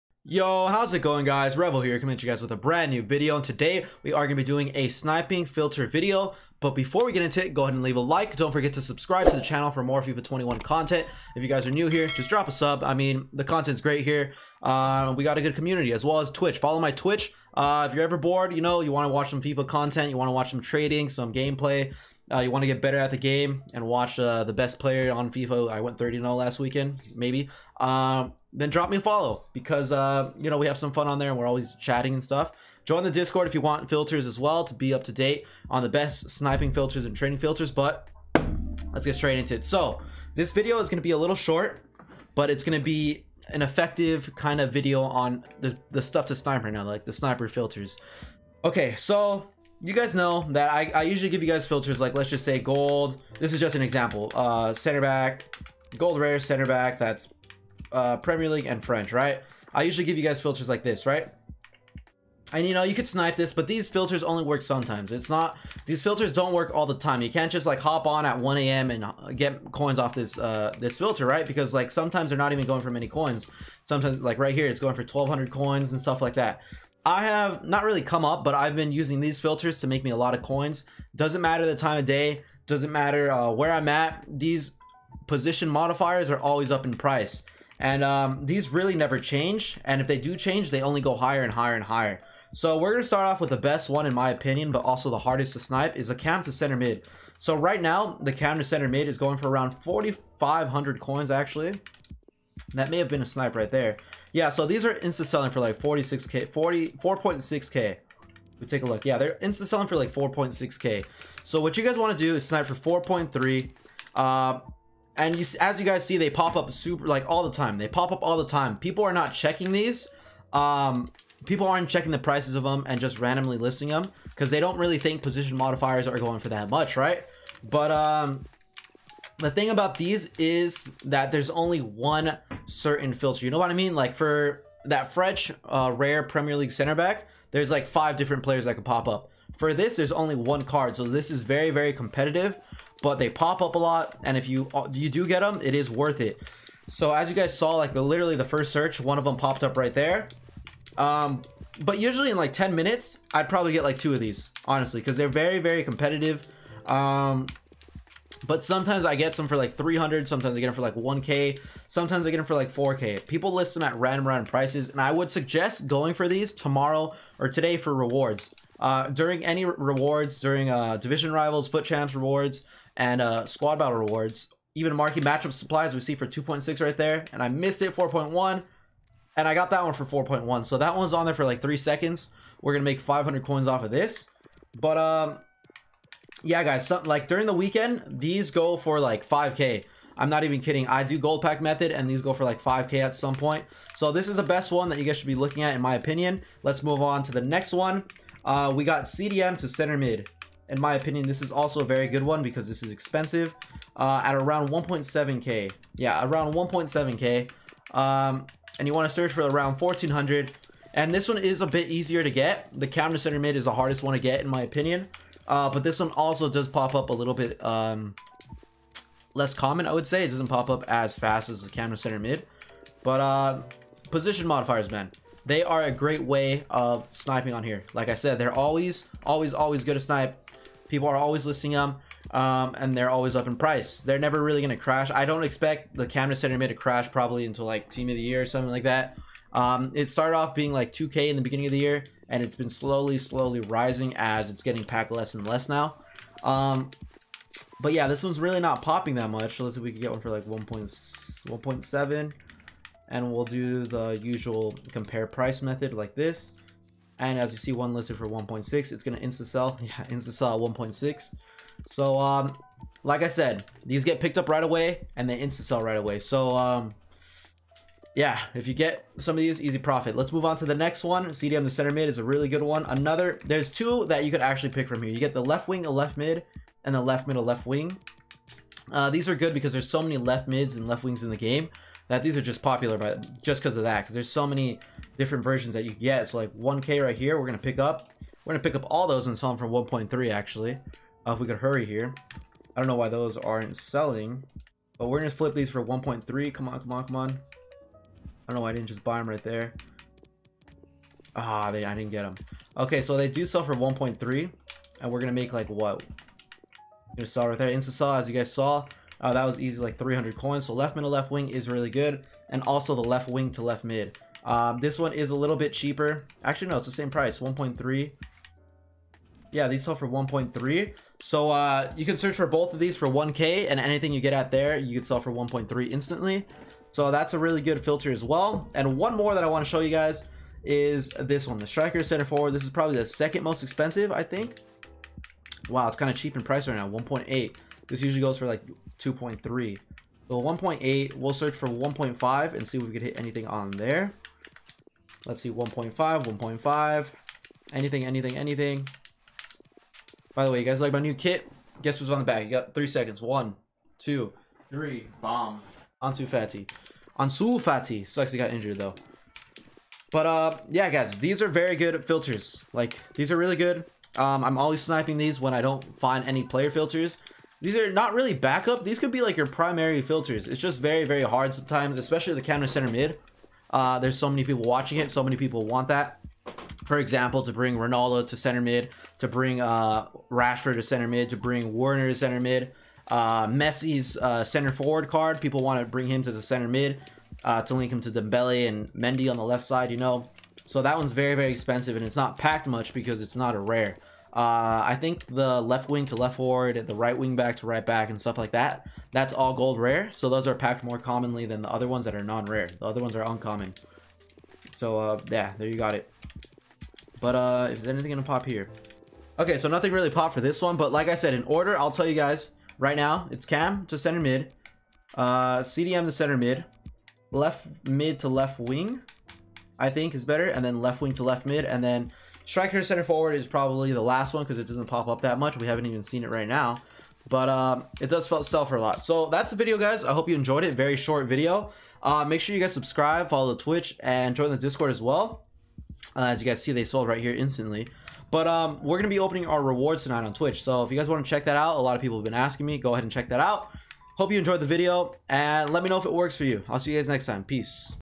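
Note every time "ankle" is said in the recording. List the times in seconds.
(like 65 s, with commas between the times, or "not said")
not said.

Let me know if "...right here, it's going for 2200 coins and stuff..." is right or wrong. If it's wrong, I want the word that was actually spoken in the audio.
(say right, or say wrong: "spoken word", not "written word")
wrong: "1200", not "2200".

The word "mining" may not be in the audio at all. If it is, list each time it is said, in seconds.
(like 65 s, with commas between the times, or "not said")
not said.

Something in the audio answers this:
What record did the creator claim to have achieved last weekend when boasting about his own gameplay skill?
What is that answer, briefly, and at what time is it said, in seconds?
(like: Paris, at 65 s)
30-0, at 25 s.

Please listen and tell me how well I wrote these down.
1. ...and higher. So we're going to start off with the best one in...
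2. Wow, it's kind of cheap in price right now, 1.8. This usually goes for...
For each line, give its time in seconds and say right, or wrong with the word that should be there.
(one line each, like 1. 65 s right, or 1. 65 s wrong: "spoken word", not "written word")
1. 91 s right
2. 335 s right.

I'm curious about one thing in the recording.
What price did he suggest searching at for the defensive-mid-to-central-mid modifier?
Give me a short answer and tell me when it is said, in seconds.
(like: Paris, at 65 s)
1,400, at 209 s.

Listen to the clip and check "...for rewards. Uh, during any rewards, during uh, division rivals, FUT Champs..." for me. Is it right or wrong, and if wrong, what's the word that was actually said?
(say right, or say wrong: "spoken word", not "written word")
right.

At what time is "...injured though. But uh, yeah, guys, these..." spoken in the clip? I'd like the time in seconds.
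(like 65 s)
358 s.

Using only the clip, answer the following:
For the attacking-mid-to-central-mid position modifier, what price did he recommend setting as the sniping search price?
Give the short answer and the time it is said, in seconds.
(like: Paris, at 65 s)
4.3k, at 113 s.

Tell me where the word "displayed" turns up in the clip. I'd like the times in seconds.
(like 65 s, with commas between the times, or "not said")
not said.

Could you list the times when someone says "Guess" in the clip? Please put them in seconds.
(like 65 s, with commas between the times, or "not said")
351 s.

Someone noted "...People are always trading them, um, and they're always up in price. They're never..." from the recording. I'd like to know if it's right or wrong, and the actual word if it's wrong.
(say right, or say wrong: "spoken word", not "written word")
wrong: "listing", not "trading".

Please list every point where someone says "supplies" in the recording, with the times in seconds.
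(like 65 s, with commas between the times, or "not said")
175 s.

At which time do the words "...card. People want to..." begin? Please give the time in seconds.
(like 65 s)
385 s.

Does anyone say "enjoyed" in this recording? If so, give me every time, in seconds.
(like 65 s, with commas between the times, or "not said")
430 s, 444 s.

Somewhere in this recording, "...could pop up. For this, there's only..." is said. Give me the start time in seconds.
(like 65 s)
138 s.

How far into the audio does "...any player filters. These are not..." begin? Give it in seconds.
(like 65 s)
366 s.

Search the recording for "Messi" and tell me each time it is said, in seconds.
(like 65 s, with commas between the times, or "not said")
383 s.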